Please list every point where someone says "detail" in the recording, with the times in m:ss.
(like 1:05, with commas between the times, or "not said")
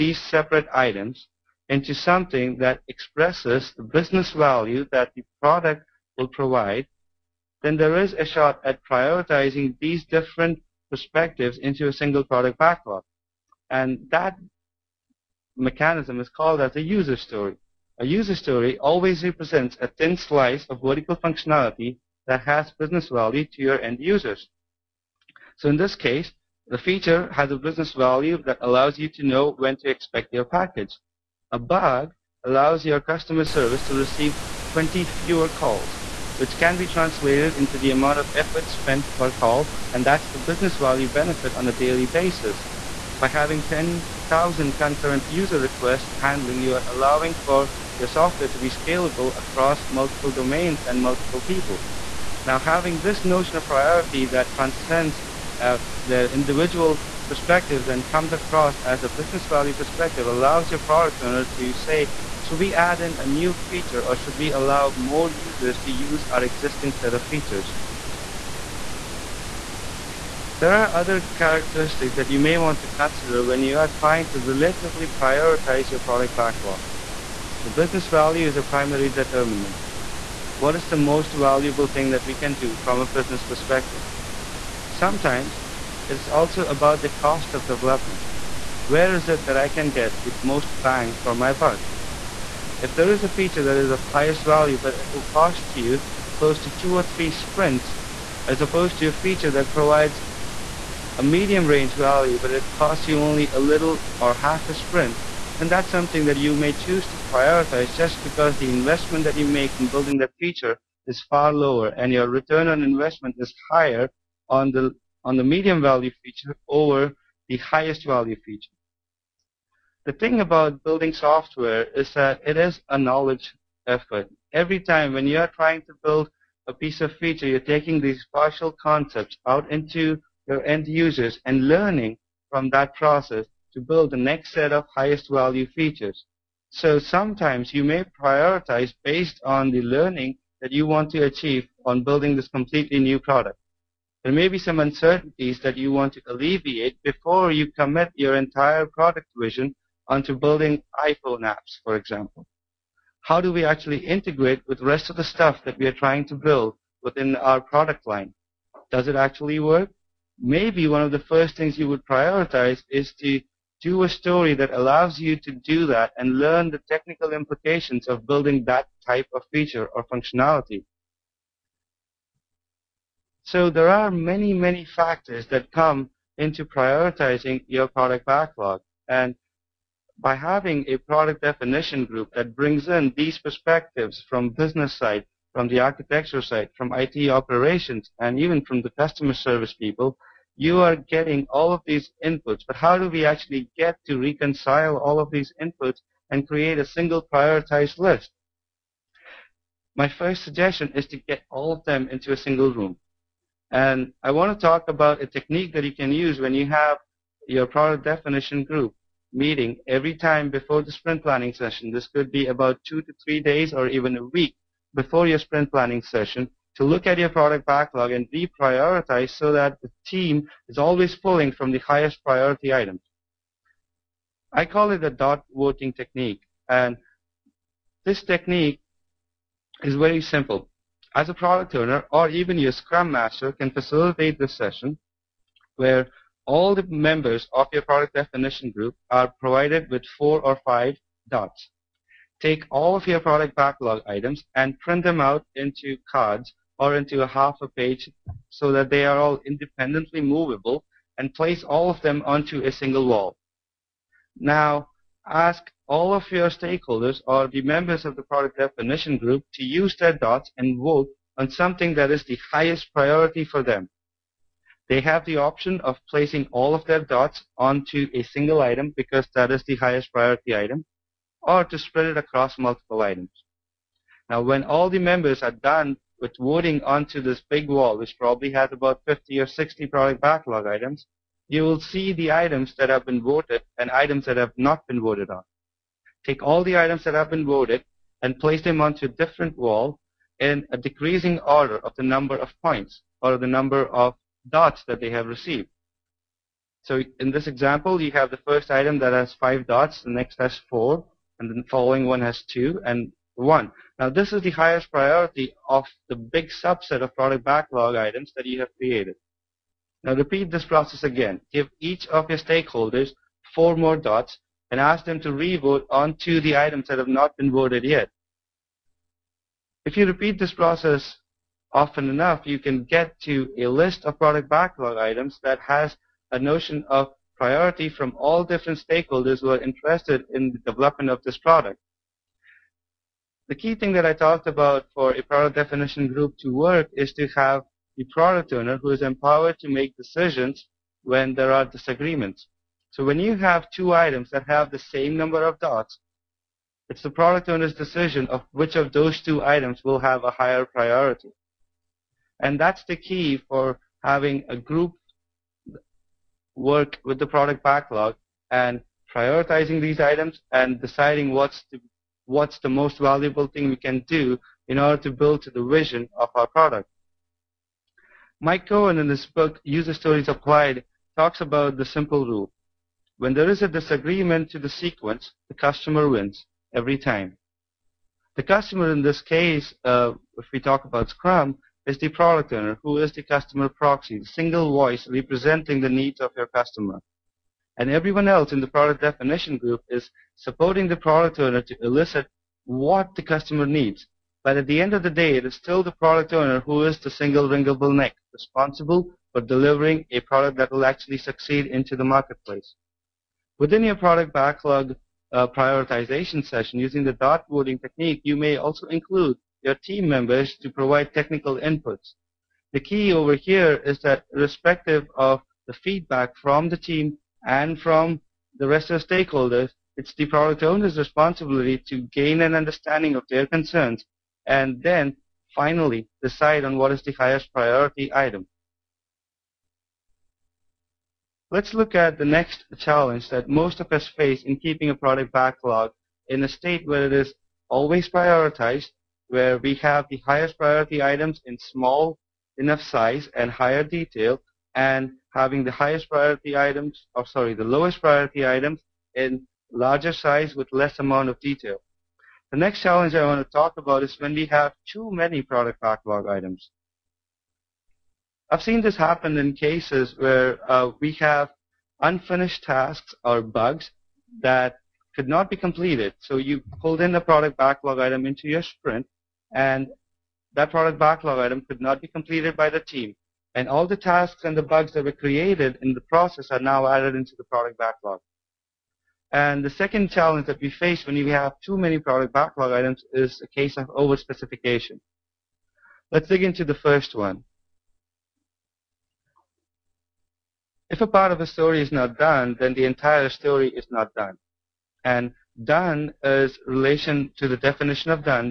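7:23, 7:31.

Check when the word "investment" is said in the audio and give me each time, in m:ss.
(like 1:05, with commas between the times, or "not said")
1:48, 1:52.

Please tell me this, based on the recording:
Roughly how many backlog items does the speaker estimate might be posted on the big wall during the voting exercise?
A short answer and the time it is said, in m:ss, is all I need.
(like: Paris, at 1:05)
50 or 60, at 4:39.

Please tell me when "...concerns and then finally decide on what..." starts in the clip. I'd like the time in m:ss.
7:03.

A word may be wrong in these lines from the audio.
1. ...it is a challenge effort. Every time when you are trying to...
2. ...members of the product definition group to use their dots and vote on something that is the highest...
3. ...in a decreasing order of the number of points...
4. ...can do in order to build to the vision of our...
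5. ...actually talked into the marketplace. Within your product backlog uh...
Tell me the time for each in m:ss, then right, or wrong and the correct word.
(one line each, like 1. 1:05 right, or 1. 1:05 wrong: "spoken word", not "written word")
1. 2:02 wrong: "knowledge", not "challenge"
2. 4:17 right
3. 4:50 right
4. 6:03 right
5. 6:40 wrong: "succeed", not "talked".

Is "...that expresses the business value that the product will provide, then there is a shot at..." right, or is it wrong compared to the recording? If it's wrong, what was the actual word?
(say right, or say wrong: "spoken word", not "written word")
right.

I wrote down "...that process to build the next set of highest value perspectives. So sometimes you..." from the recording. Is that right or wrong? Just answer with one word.
wrong.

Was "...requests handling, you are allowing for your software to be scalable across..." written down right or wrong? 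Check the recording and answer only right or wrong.
right.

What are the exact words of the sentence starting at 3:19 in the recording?
My first suggestion is to get all of them into a single room.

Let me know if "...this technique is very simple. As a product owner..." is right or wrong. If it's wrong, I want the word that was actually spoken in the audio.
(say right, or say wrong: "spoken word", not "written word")
right.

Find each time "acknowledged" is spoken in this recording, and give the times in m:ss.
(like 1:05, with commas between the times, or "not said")
not said.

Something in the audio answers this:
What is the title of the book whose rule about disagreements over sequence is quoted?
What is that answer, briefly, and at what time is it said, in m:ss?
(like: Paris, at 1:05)
User Stories Applied, at 6:09.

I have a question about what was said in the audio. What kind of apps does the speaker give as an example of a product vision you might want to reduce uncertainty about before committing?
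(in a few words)
iPhone apps.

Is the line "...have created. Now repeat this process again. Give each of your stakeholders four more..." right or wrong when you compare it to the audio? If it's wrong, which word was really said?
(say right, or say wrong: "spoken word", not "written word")
right.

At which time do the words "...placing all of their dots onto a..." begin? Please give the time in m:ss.
4:26.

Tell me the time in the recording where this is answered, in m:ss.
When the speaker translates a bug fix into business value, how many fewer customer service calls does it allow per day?
0:34.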